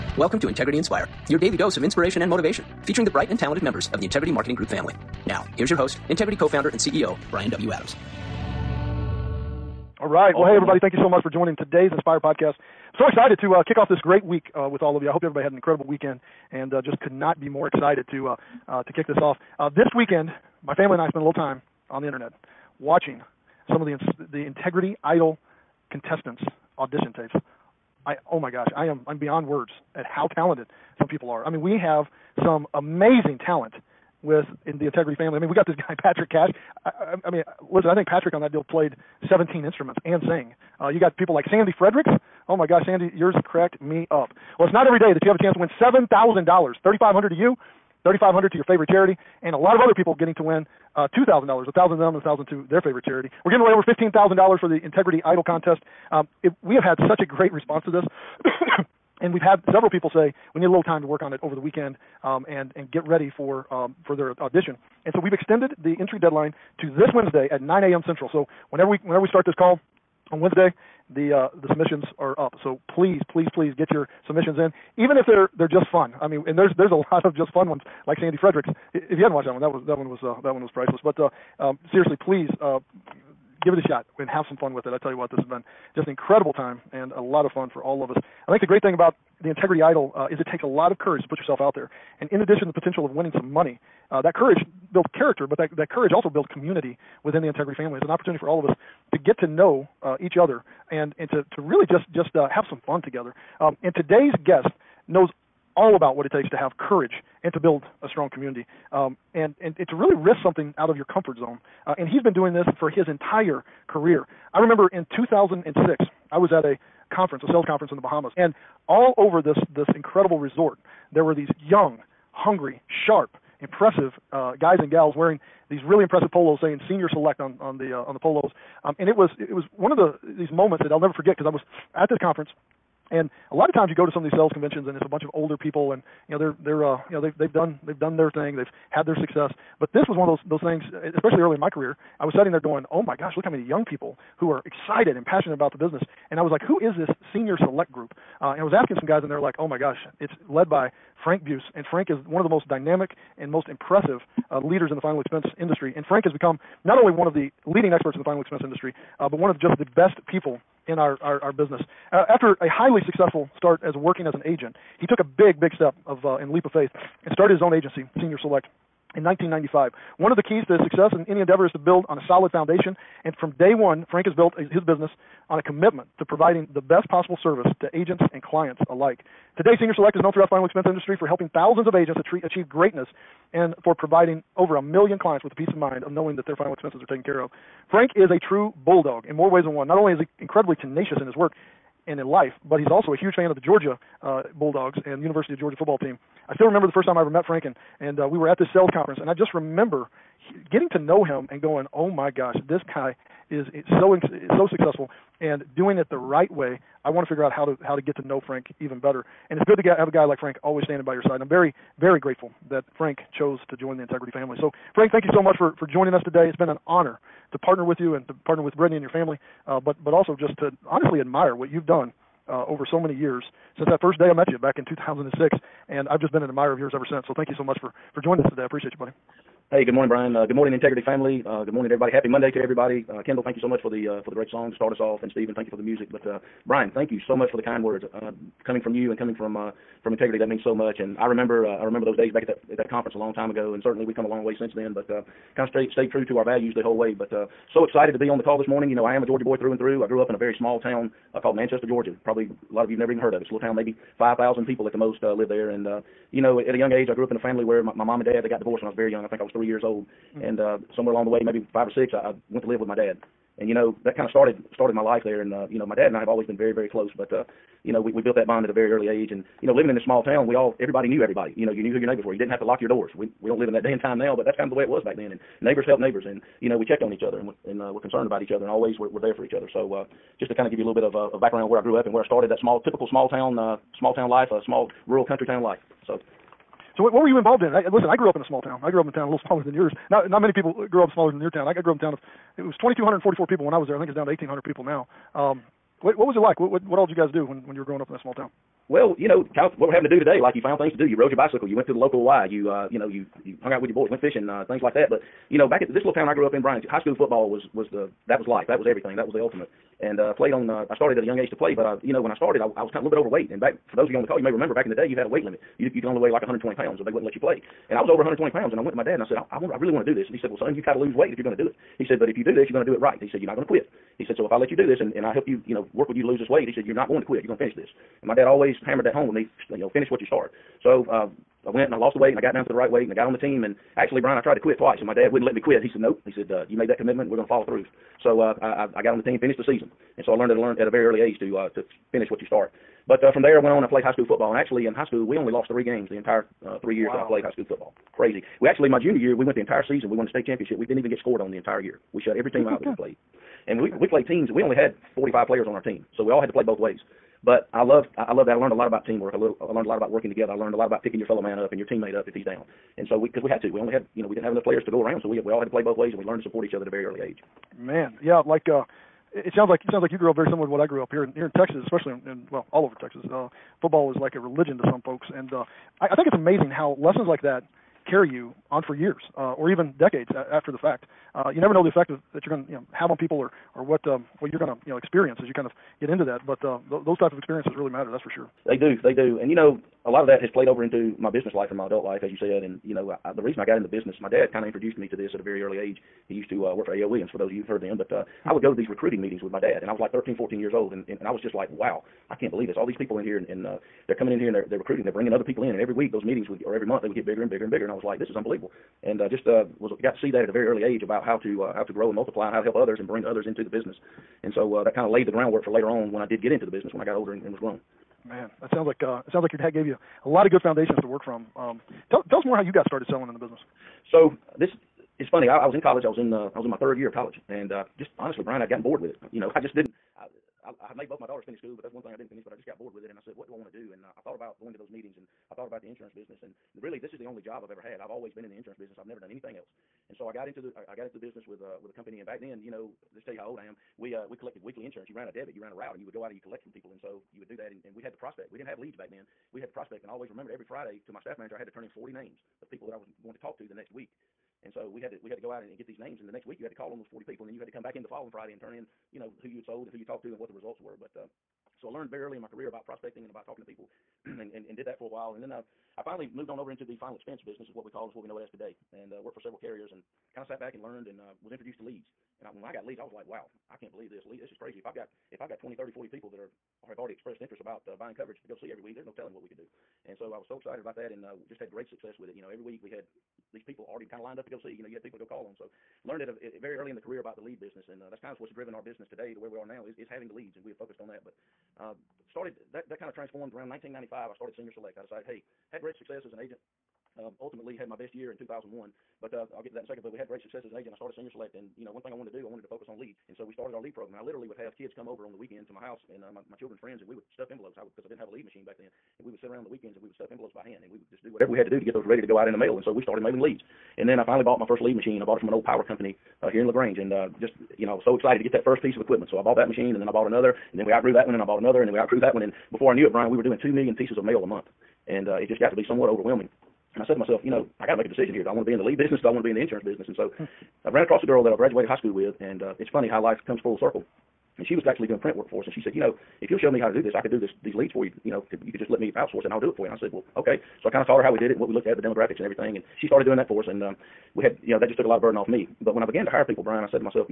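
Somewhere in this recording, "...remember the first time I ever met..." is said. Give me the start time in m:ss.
3:16.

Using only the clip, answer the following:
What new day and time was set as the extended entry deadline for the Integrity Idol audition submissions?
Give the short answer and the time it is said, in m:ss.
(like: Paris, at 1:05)
Wednesday at 9 a.m. Central, at 1:07.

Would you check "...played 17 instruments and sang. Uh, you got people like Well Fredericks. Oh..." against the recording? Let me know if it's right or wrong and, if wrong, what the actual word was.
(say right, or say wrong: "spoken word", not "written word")
wrong: "Sandy", not "Well".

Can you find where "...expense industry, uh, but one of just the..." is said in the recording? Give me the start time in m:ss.
2:38.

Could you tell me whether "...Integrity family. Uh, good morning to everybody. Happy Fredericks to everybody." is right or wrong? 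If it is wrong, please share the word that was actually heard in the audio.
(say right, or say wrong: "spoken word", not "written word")
wrong: "Monday", not "Fredericks".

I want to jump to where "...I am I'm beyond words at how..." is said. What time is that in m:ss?
0:28.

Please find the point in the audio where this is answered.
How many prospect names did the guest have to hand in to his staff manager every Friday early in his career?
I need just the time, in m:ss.
7:31.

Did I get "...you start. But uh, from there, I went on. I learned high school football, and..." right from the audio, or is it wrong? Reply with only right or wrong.
wrong.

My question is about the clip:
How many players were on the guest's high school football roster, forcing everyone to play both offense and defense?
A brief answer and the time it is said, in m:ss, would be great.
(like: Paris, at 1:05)
45, at 5:55.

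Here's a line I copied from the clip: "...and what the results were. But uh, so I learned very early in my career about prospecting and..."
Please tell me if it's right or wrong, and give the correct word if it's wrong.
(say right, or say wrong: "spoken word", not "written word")
right.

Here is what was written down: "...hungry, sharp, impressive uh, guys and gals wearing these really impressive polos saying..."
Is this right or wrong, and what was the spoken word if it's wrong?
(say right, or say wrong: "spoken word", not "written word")
right.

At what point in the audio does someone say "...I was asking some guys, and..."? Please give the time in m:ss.
2:28.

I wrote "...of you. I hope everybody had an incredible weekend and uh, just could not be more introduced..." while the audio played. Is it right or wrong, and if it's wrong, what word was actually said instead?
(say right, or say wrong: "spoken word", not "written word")
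wrong: "excited", not "introduced".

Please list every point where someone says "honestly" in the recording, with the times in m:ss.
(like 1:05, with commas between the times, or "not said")
3:40, 7:08.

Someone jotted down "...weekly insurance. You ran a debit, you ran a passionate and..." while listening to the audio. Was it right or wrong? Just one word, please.
wrong.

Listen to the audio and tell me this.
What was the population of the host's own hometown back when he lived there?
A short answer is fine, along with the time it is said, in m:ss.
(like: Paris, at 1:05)
2,244, at 4:52.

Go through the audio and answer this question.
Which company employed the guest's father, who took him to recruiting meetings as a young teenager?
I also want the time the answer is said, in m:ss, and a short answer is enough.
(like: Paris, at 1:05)
A.L. Williams, at 6:36.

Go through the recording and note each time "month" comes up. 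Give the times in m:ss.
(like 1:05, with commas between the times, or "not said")
6:46, 8:44.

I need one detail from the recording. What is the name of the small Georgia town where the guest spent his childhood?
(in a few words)
Manchester.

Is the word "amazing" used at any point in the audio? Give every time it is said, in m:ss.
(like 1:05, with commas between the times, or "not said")
0:32, 6:16.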